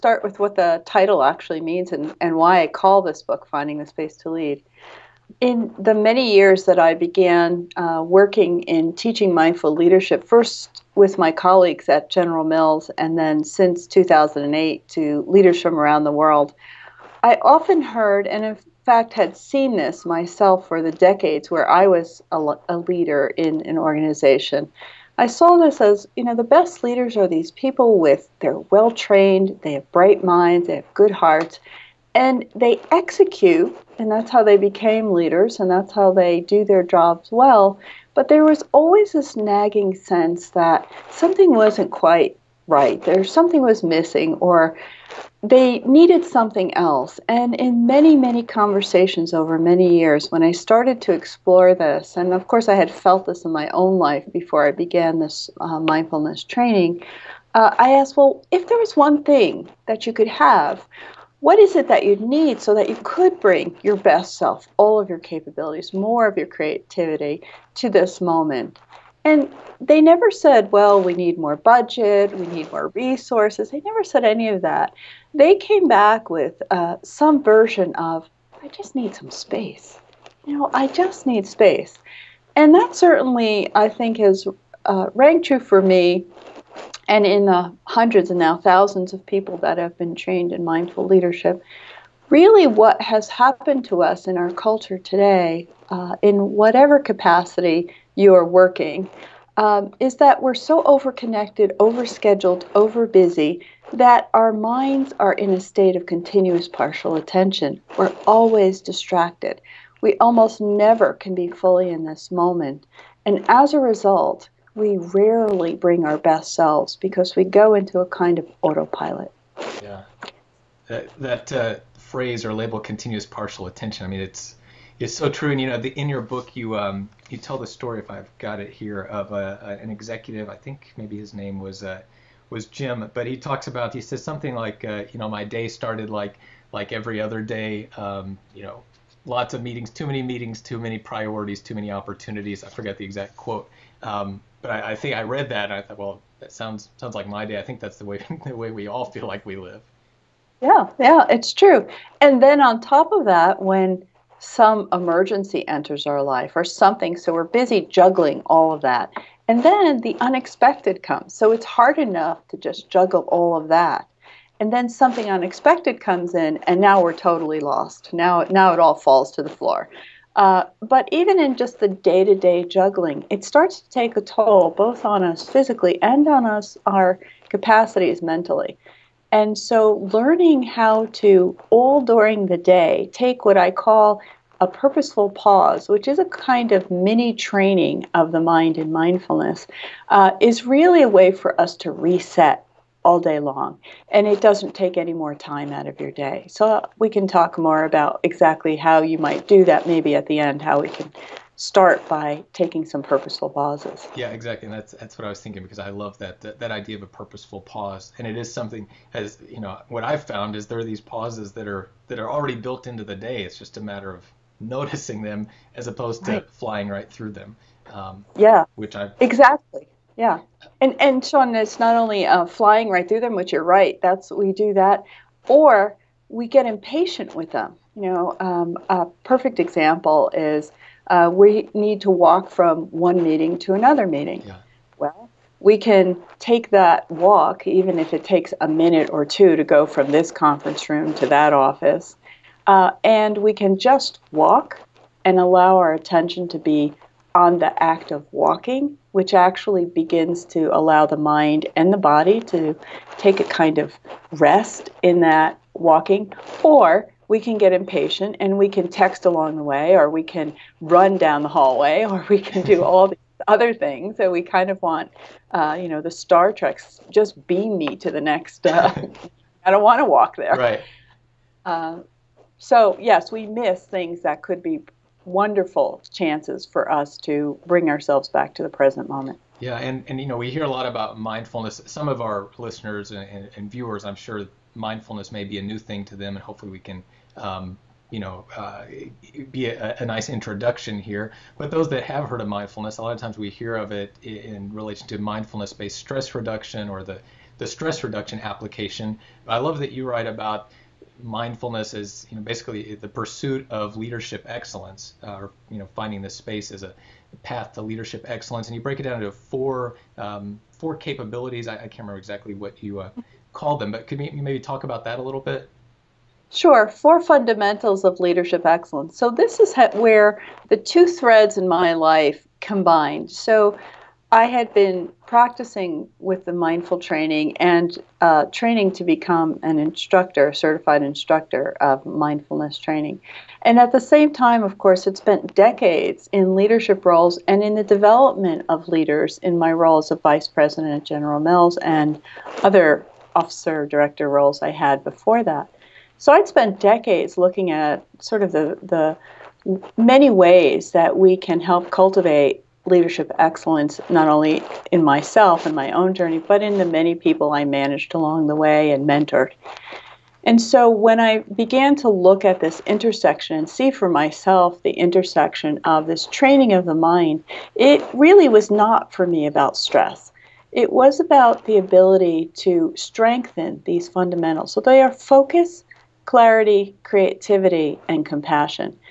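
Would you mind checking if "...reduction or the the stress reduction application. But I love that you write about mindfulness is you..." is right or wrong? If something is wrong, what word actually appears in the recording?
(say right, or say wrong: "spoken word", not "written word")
right.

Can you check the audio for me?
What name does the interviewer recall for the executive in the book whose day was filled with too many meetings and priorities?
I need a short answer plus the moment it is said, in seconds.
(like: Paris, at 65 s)
Jim, at 132 s.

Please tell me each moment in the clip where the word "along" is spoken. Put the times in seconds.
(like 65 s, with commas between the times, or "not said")
259 s, 358 s.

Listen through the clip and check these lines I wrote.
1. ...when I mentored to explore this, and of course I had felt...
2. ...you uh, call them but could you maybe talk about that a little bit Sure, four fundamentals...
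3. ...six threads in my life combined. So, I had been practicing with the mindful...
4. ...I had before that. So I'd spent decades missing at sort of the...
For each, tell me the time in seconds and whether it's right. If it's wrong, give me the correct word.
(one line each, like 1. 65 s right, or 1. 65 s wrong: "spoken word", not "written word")
1. 50 s wrong: "started", not "mentored"
2. 312 s right
3. 320 s wrong: "two", not "six"
4. 344 s wrong: "looking", not "missing".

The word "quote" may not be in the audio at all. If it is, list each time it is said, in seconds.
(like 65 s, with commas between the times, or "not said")
143 s.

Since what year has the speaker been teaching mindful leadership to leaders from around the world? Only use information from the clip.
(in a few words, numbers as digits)
2008.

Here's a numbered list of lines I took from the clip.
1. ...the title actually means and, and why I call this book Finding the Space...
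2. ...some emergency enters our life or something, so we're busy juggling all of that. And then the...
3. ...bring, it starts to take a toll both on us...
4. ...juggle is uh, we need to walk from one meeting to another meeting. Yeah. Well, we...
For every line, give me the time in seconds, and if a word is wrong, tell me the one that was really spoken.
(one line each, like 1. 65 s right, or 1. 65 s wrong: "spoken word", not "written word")
1. 0 s right
2. 154 s right
3. 172 s wrong: "juggling", not "bring"
4. 229 s wrong: "example", not "juggle".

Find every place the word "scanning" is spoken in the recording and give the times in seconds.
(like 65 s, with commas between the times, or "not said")
not said.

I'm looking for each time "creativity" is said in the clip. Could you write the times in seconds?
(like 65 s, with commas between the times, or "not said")
66 s, 377 s.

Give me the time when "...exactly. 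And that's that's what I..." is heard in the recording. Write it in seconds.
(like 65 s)
204 s.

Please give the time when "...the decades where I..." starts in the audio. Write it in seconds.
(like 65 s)
20 s.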